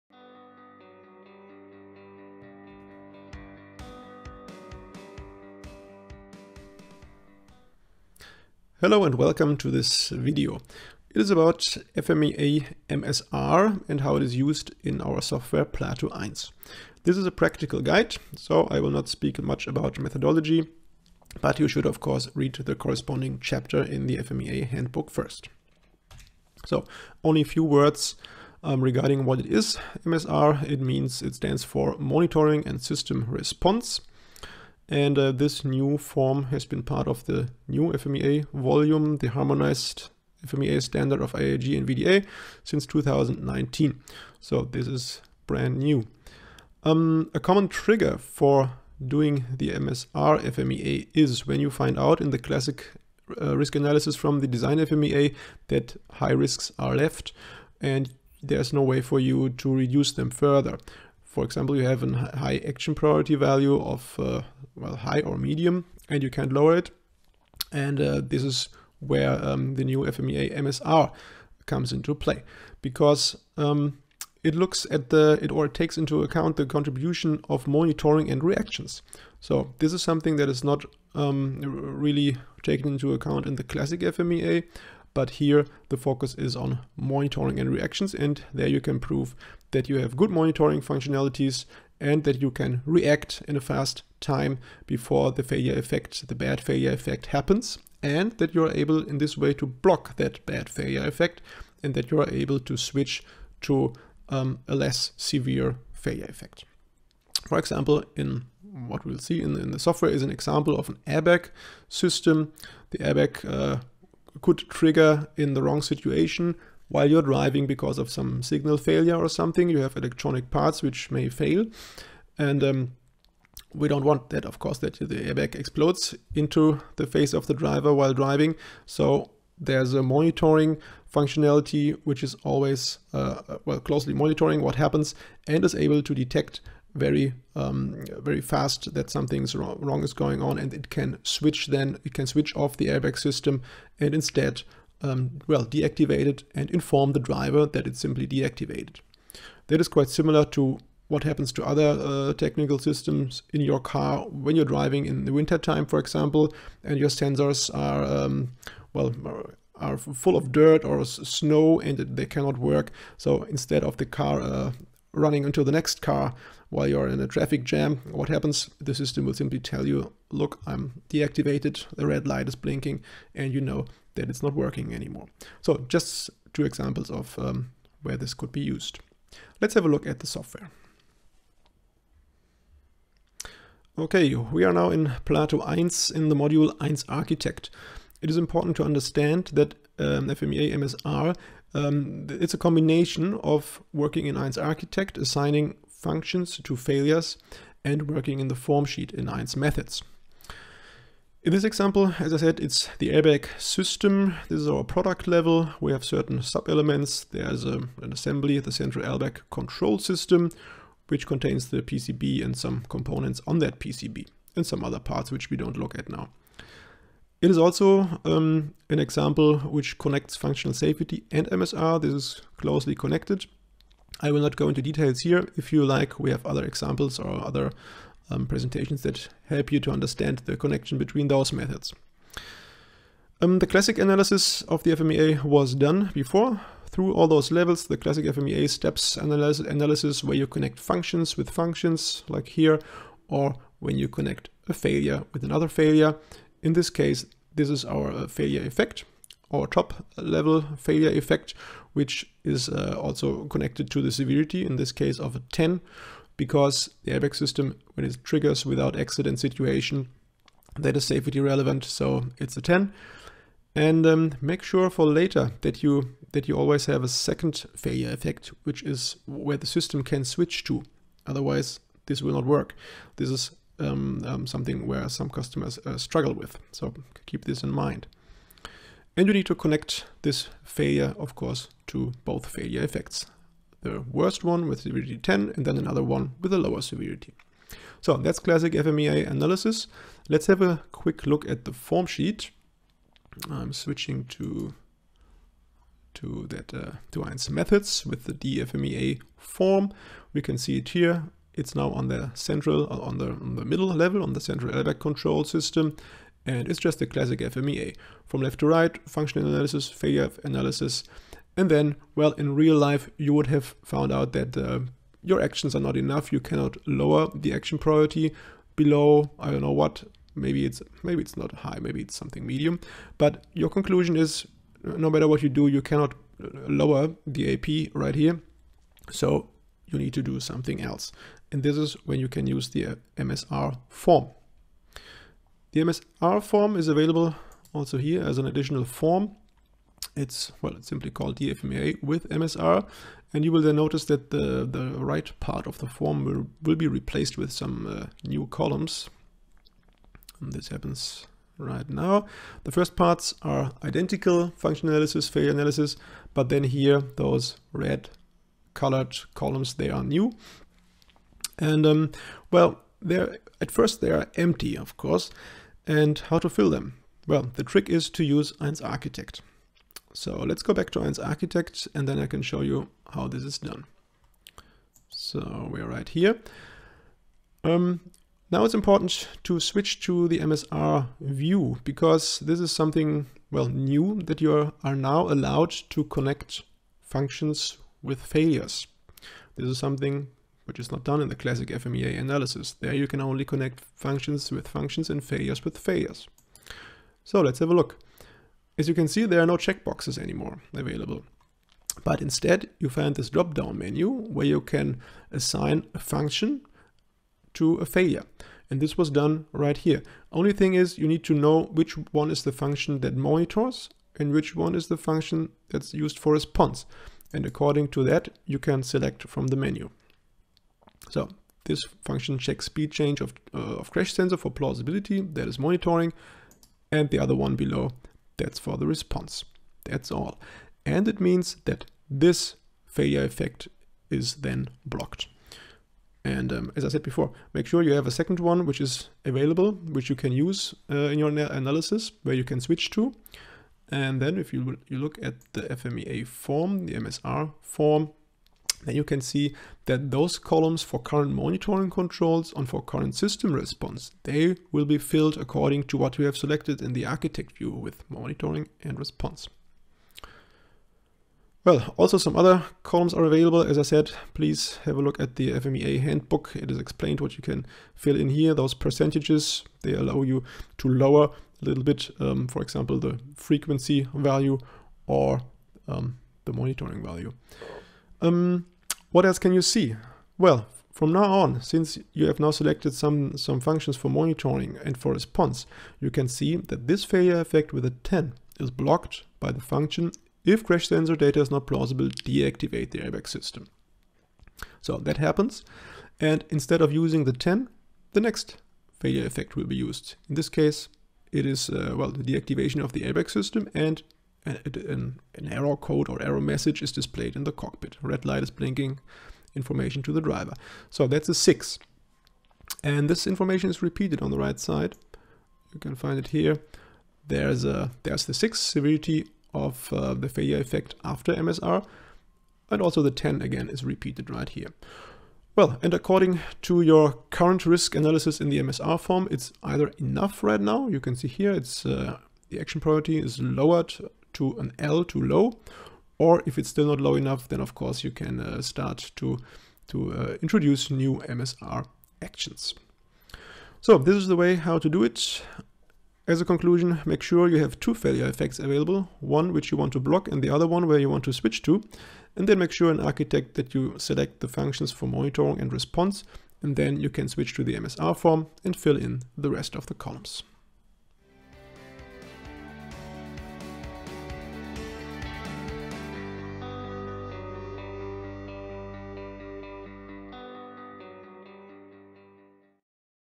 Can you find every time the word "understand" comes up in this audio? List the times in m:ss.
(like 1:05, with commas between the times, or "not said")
3:08, 3:49.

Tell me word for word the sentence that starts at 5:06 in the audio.
And it's just a classic FMEA.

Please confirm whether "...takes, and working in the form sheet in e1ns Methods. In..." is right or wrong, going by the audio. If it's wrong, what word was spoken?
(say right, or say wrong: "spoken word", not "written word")
wrong: "failures", not "takes".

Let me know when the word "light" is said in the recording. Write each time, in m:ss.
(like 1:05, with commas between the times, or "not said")
2:52, 8:28.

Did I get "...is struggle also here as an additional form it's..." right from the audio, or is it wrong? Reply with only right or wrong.
wrong.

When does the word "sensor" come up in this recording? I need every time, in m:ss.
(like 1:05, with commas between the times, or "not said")
2:37, 7:04, 8:10.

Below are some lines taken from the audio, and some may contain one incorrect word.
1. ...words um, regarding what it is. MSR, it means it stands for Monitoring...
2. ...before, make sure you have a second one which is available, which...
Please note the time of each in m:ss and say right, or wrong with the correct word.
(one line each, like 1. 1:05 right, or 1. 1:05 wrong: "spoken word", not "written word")
1. 0:27 right
2. 7:17 right.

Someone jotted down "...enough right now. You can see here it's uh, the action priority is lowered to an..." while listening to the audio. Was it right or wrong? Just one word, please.
right.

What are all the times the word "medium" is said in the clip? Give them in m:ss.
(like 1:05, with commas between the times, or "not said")
1:05, 5:22.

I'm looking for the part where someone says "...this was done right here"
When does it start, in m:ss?
6:48.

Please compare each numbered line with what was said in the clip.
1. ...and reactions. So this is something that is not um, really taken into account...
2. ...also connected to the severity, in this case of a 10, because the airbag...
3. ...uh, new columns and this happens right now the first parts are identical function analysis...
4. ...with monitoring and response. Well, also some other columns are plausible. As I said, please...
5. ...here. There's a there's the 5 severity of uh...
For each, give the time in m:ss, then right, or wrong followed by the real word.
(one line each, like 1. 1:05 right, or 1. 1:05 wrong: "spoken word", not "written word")
1. 1:18 right
2. 4:13 right
3. 5:47 right
4. 7:37 wrong: "available", not "plausible"
5. 8:36 wrong: "6", not "5".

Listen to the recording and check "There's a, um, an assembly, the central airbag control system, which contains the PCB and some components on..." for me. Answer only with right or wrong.
right.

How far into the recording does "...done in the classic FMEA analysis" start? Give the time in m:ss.
6:31.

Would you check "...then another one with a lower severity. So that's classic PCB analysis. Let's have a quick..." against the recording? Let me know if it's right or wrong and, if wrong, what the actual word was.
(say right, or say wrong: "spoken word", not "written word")
wrong: "FMEA", not "PCB".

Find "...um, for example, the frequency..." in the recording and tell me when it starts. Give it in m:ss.
7:52.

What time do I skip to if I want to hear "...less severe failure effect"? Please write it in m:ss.
1:44.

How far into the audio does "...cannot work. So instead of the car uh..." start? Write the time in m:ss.
2:42.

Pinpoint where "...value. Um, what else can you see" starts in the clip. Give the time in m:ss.
7:57.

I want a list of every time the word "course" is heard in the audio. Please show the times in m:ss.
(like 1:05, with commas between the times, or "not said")
0:21, 2:04, 4:41, 6:04, 8:57.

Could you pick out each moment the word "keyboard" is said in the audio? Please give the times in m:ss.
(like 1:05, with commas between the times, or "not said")
not said.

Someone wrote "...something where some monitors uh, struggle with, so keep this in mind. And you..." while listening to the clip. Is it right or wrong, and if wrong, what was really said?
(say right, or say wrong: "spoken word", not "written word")
wrong: "customers", not "monitors".